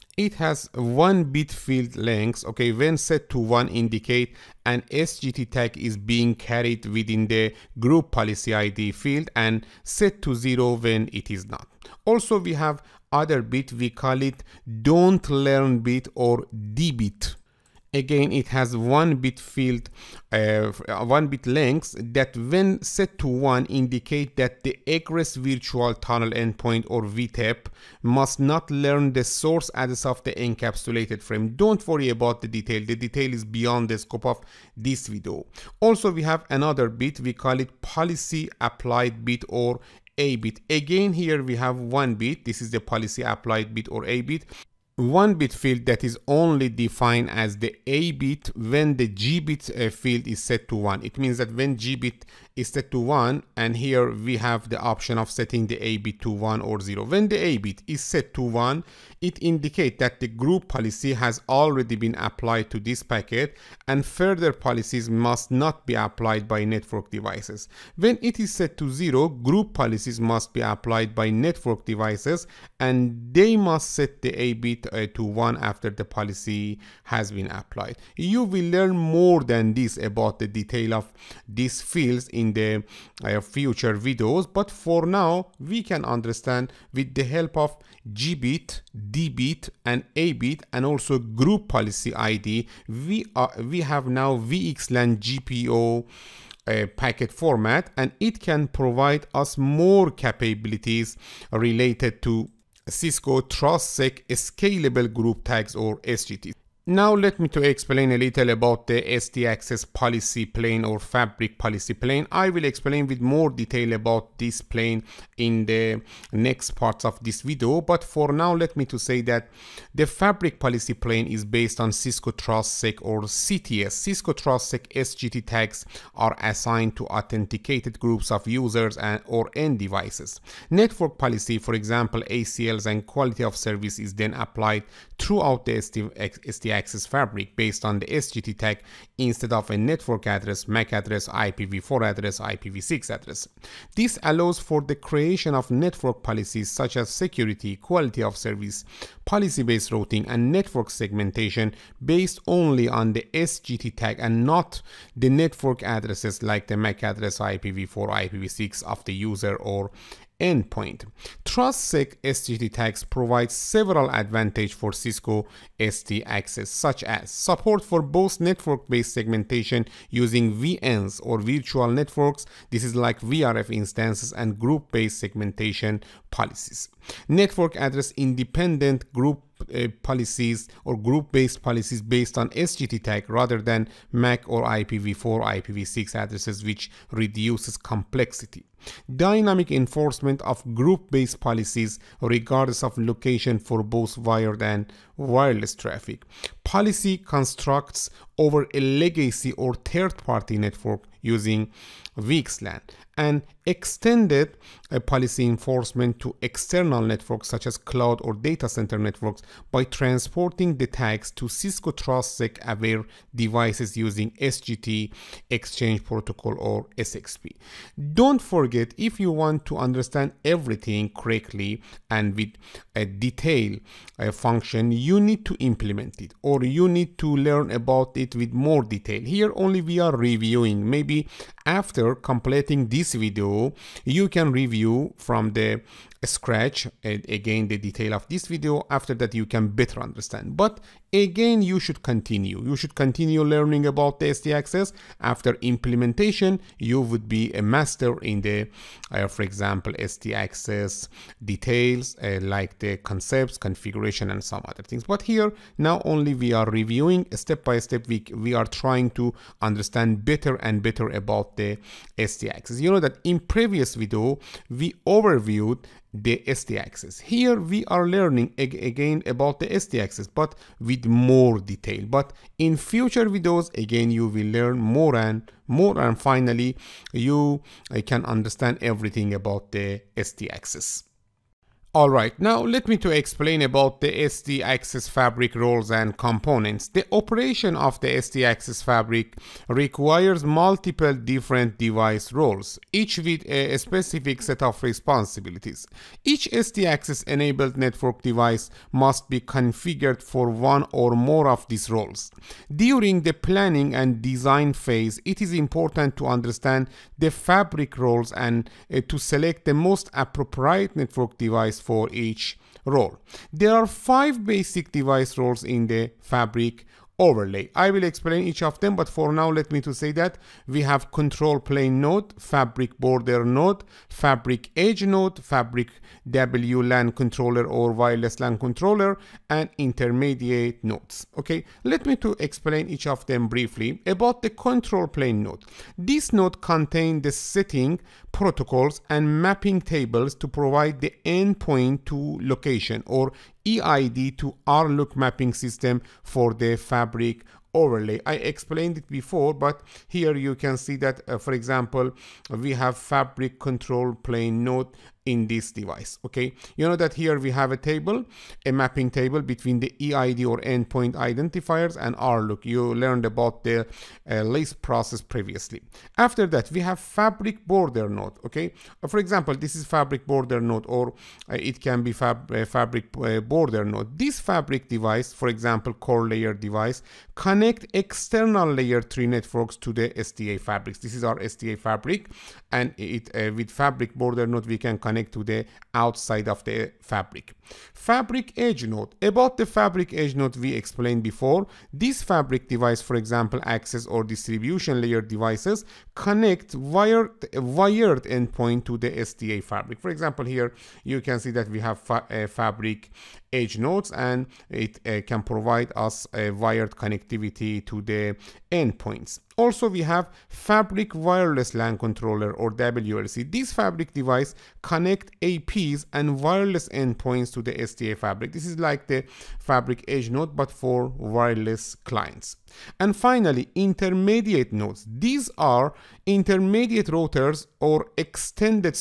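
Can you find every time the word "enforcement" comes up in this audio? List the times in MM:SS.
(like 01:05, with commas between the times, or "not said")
03:09, 03:25.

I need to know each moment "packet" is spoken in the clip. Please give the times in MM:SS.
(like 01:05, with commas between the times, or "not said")
01:03, 01:36.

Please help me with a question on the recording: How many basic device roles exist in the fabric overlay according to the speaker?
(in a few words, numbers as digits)
5.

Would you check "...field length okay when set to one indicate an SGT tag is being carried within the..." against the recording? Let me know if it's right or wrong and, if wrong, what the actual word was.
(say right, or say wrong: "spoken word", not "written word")
right.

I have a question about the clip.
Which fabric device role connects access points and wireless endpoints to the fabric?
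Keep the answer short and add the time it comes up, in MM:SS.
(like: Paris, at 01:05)
Fabric Wireless LAN Controller, at 06:50.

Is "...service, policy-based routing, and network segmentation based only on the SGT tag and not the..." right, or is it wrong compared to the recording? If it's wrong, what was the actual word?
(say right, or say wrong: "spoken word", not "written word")
right.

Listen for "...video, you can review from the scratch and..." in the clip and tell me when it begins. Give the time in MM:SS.
03:53.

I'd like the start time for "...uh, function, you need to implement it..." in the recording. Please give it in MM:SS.
03:44.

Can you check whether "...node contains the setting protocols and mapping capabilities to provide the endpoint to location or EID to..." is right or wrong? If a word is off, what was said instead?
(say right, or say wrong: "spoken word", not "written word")
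wrong: "tables", not "capabilities".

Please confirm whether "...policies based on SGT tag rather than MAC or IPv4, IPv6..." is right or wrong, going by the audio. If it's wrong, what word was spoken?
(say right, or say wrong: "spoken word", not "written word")
right.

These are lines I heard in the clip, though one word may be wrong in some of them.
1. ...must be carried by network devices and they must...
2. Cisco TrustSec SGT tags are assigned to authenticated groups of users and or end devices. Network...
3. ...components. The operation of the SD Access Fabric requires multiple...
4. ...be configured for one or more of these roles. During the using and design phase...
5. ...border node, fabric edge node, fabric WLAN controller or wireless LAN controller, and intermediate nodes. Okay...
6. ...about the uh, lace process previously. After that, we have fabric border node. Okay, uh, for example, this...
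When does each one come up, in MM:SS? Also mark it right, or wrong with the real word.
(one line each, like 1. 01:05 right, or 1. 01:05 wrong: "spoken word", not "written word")
1. 01:10 wrong: "applied", not "carried"
2. 02:03 right
3. 04:46 right
4. 04:59 wrong: "planning", not "using"
5. 05:22 right
6. 06:03 right.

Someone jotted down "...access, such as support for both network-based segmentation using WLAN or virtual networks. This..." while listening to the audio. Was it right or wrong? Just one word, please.
wrong.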